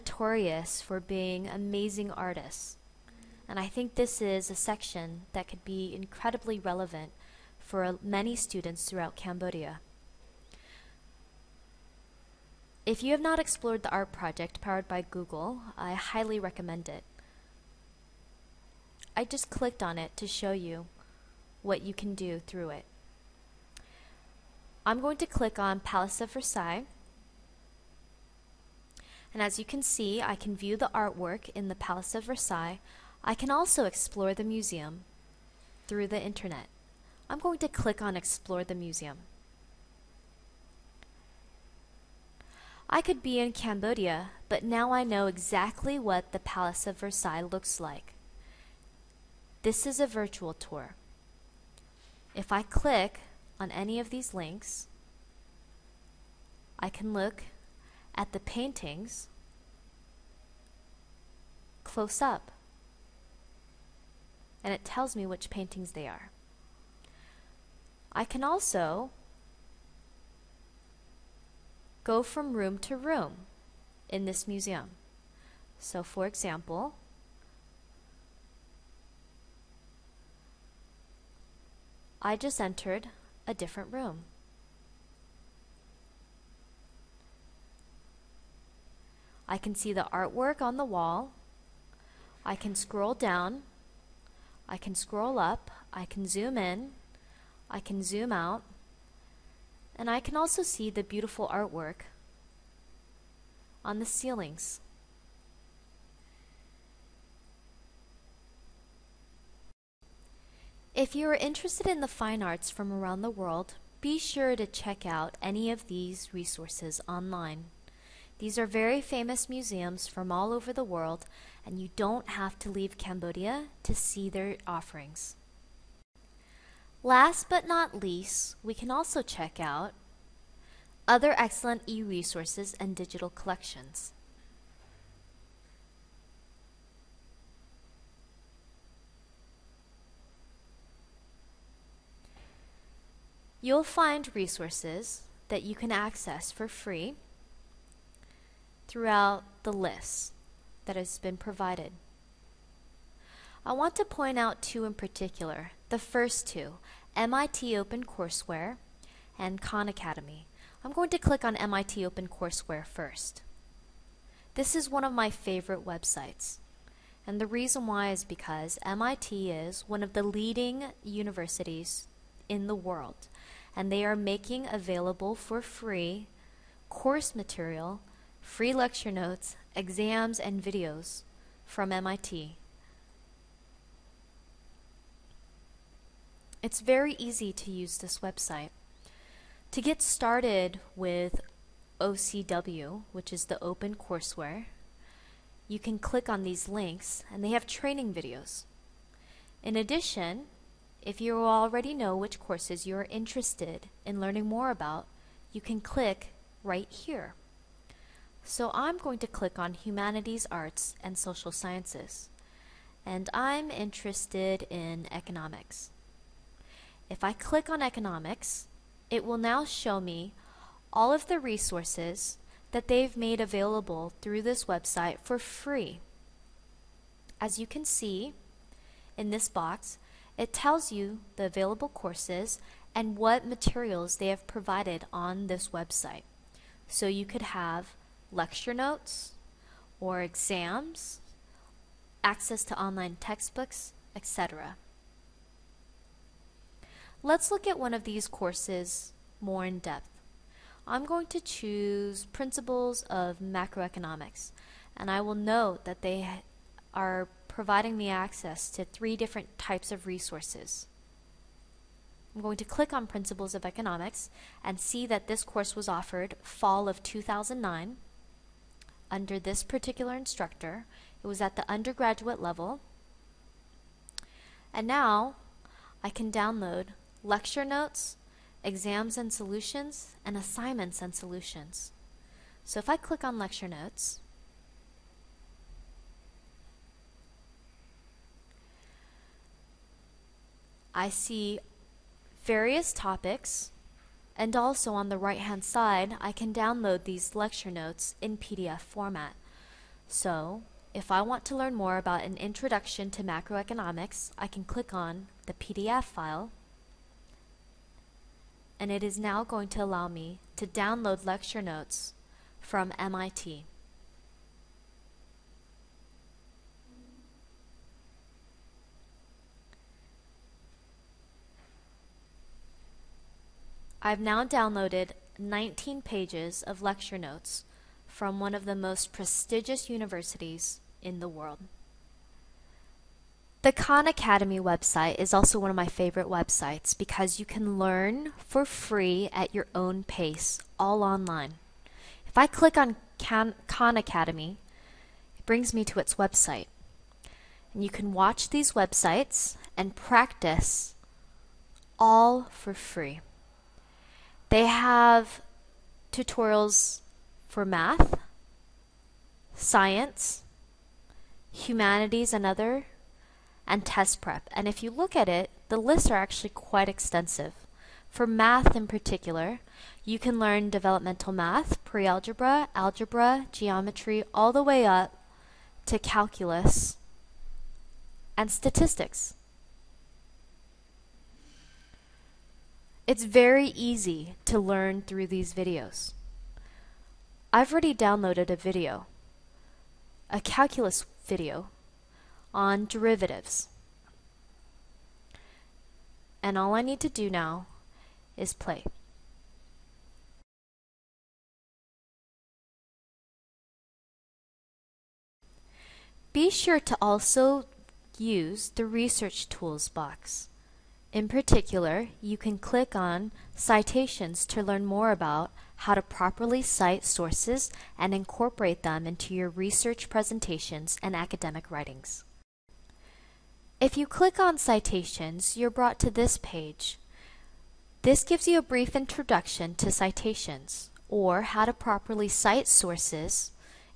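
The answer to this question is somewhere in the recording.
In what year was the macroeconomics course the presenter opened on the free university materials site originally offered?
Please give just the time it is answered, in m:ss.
4:27.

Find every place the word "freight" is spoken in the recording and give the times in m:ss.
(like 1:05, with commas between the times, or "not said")
not said.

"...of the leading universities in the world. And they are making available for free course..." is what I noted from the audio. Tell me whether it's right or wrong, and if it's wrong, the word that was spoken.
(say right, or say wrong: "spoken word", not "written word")
right.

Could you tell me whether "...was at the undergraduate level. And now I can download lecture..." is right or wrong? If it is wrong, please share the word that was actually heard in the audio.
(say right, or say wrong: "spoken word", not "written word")
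right.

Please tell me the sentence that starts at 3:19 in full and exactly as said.
In addition, if you already know which courses you are interested in learning more about, you can click right here.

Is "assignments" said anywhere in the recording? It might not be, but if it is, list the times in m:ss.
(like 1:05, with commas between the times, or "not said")
4:40.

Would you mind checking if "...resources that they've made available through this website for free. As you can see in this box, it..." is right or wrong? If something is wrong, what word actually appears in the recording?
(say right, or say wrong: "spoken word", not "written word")
right.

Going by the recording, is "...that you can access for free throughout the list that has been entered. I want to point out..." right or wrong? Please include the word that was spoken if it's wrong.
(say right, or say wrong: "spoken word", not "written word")
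wrong: "provided", not "entered".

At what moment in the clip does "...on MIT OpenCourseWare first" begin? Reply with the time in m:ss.
2:41.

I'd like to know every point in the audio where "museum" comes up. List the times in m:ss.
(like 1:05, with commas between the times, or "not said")
0:34, 0:38, 1:14, 1:59.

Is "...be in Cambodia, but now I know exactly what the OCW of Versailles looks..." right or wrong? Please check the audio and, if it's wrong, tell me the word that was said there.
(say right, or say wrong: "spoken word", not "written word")
wrong: "Palace", not "OCW".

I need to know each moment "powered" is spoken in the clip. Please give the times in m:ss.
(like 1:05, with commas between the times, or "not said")
0:14.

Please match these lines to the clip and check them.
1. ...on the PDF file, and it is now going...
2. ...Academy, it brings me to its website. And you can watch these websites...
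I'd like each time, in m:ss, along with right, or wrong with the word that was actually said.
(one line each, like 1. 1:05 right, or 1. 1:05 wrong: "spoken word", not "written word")
1. 5:04 right
2. 5:43 right.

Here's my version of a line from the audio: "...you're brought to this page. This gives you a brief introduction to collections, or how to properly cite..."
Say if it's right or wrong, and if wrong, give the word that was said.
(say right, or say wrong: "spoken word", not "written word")
wrong: "citations", not "collections".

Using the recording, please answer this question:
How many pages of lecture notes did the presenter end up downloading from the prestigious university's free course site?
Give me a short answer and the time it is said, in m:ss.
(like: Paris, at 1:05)
19, at 5:25.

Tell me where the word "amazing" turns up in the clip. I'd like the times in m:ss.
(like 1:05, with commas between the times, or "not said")
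0:01.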